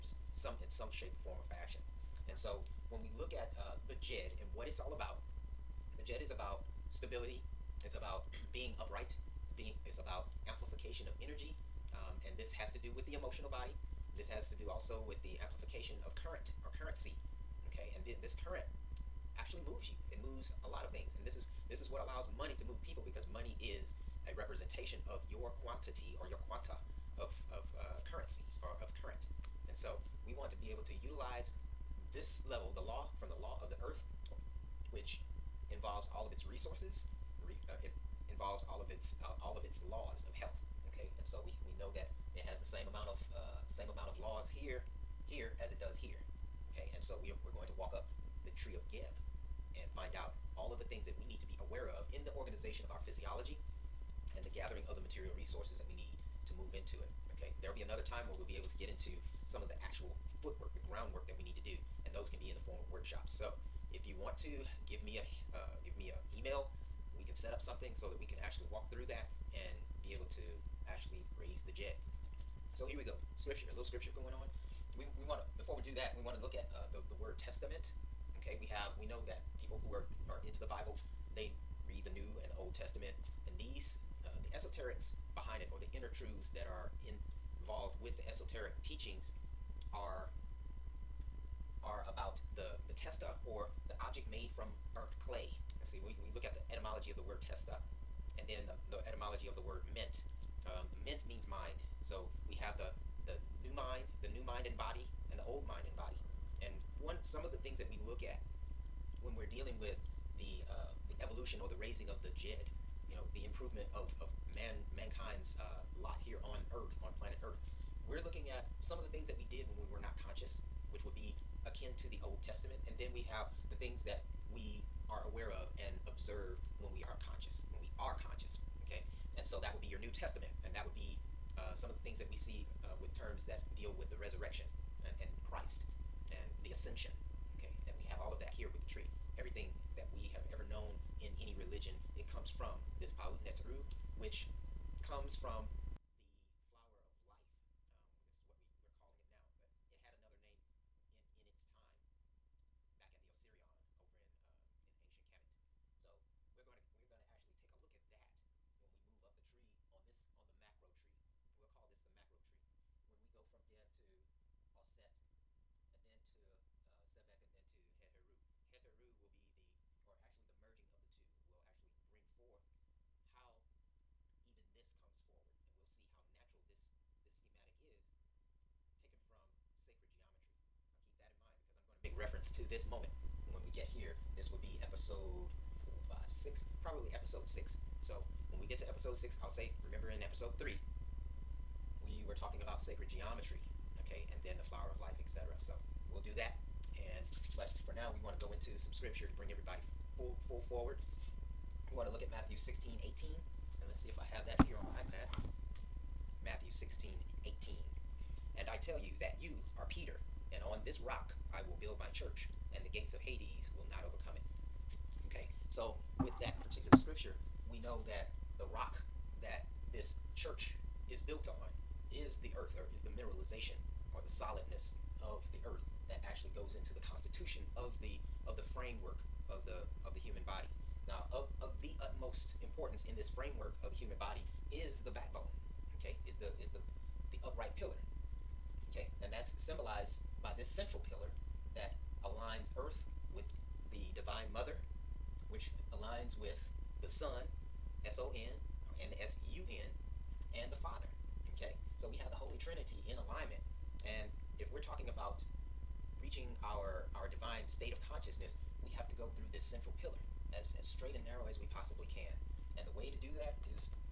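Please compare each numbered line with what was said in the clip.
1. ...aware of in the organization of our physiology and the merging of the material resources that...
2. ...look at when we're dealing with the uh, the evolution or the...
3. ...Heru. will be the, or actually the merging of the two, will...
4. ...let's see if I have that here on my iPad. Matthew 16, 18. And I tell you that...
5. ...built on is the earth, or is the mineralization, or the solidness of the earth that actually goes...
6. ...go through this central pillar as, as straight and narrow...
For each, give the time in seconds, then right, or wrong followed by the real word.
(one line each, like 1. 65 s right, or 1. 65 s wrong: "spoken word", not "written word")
1. 51 s wrong: "gathering", not "merging"
2. 108 s right
3. 168 s right
4. 203 s right
5. 221 s right
6. 259 s right.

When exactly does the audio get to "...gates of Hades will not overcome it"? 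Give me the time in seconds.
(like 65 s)
212 s.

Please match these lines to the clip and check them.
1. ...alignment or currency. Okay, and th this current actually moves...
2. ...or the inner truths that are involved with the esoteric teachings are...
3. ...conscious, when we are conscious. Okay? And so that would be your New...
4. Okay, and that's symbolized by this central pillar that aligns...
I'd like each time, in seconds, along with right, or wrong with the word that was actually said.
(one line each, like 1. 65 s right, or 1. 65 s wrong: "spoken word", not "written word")
1. 16 s wrong: "current", not "alignment"
2. 85 s right
3. 127 s right
4. 238 s right.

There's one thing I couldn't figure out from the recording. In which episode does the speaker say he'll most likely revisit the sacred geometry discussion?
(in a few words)
episode 6.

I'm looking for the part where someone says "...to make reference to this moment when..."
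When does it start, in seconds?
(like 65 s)
181 s.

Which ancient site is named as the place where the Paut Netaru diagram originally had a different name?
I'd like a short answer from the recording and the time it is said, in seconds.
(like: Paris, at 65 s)
the Osirion, at 153 s.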